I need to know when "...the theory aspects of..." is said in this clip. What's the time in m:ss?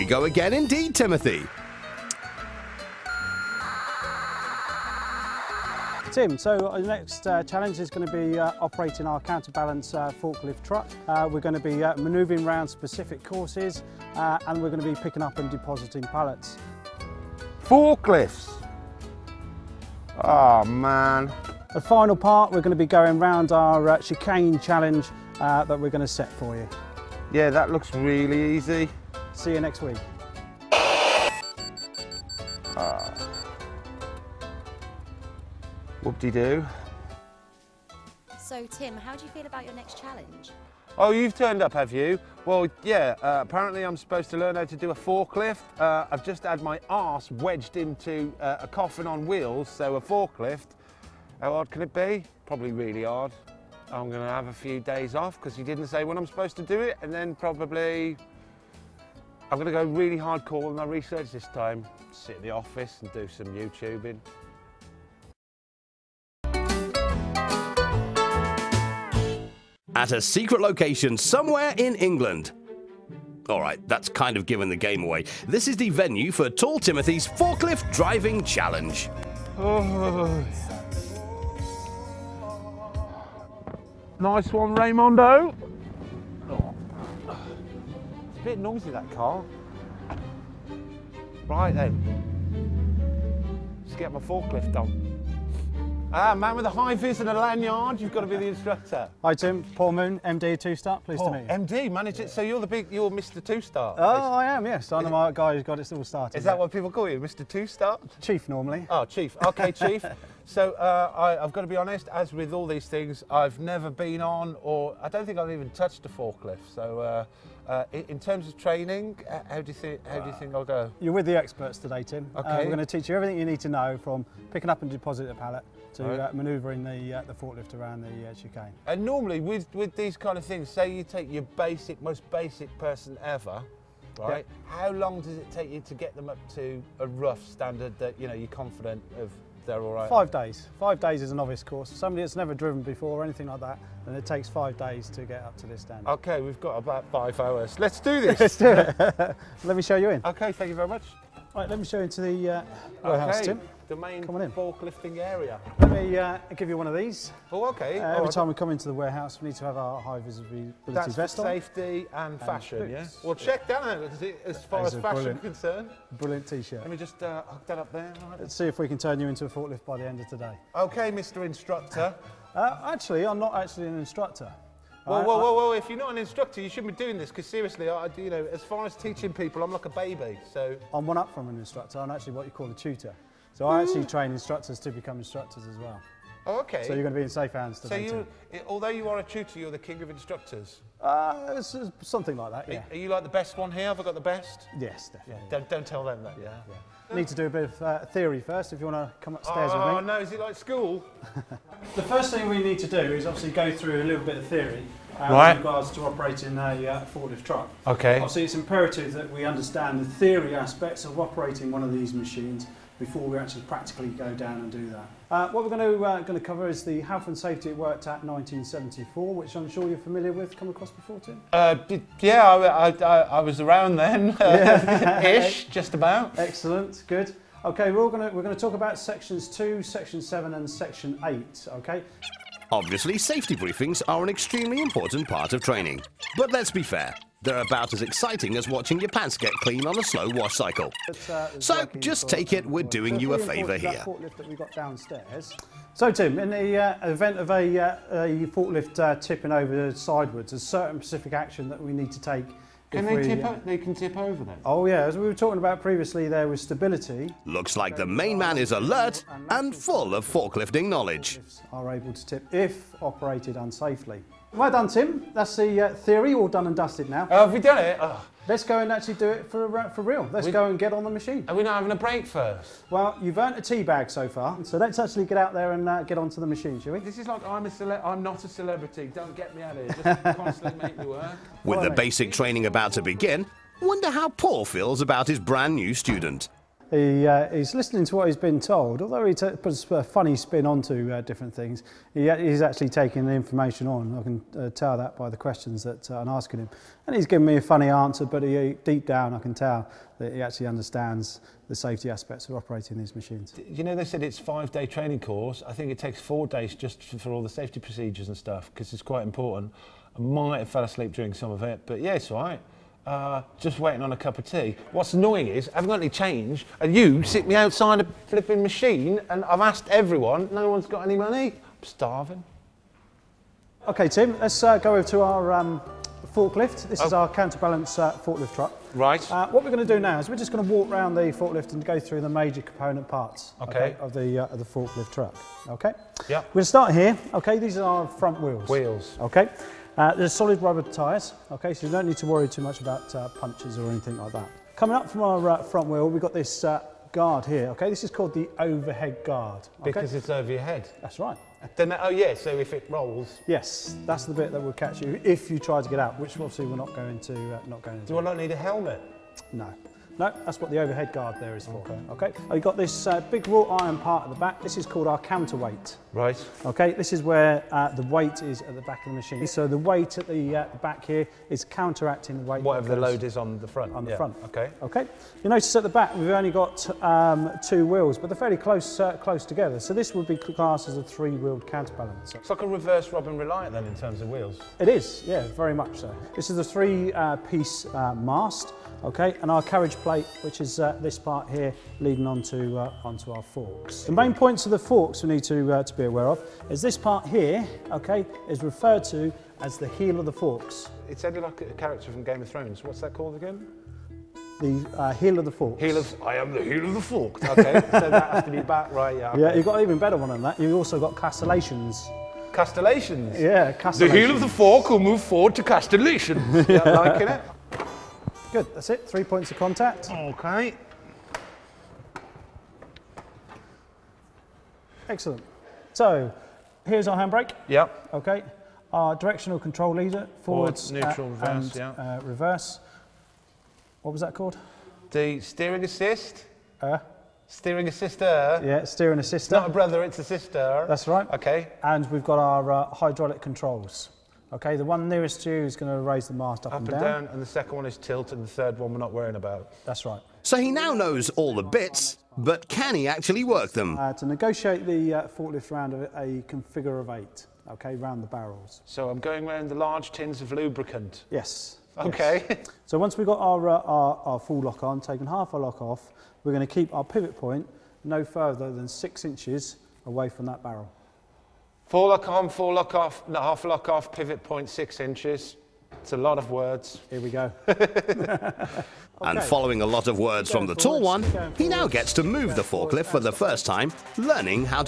3:30.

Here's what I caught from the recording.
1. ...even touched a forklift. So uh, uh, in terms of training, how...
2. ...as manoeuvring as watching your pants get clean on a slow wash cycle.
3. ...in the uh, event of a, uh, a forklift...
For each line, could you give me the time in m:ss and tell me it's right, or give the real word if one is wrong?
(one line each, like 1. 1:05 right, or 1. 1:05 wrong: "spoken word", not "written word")
1. 1:55 right
2. 3:57 wrong: "exciting", not "manoeuvring"
3. 4:06 right.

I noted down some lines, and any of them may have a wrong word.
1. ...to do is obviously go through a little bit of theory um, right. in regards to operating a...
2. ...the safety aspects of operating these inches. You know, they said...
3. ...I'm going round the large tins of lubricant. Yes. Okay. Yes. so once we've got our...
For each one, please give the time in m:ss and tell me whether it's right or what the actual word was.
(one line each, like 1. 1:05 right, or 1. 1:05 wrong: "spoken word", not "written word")
1. 3:22 right
2. 5:01 wrong: "machines", not "inches"
3. 7:39 right.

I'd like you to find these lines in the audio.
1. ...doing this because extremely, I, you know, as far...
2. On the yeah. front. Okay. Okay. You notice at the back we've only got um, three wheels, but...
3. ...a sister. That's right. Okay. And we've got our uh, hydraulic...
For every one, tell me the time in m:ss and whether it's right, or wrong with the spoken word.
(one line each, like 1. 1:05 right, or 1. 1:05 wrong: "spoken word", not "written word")
1. 2:57 wrong: "seriously", not "extremely"
2. 6:13 wrong: "two", not "three"
3. 7:20 right.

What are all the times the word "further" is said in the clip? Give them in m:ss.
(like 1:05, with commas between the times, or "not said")
7:48.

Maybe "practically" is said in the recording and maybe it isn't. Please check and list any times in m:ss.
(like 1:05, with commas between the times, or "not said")
3:33.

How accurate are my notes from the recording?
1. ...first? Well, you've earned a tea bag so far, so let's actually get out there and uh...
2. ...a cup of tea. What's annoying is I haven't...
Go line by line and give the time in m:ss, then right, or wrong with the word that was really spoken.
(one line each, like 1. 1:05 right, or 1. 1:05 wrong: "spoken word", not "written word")
1. 4:32 right
2. 5:14 right.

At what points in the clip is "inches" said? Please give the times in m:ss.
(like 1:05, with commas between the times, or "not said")
7:49, 7:55.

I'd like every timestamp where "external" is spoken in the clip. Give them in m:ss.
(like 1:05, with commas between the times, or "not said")
not said.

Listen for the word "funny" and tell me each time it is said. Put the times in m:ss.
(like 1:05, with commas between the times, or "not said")
4:50, 4:57.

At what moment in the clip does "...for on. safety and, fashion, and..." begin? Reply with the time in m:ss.
2:41.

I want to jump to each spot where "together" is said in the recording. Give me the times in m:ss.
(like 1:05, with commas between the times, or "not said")
6:19.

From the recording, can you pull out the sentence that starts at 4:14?
Oh yeah, as we were talking about previously, there was stability.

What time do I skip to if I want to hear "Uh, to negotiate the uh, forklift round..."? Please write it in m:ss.
7:33.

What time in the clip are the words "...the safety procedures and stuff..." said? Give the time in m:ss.
5:07.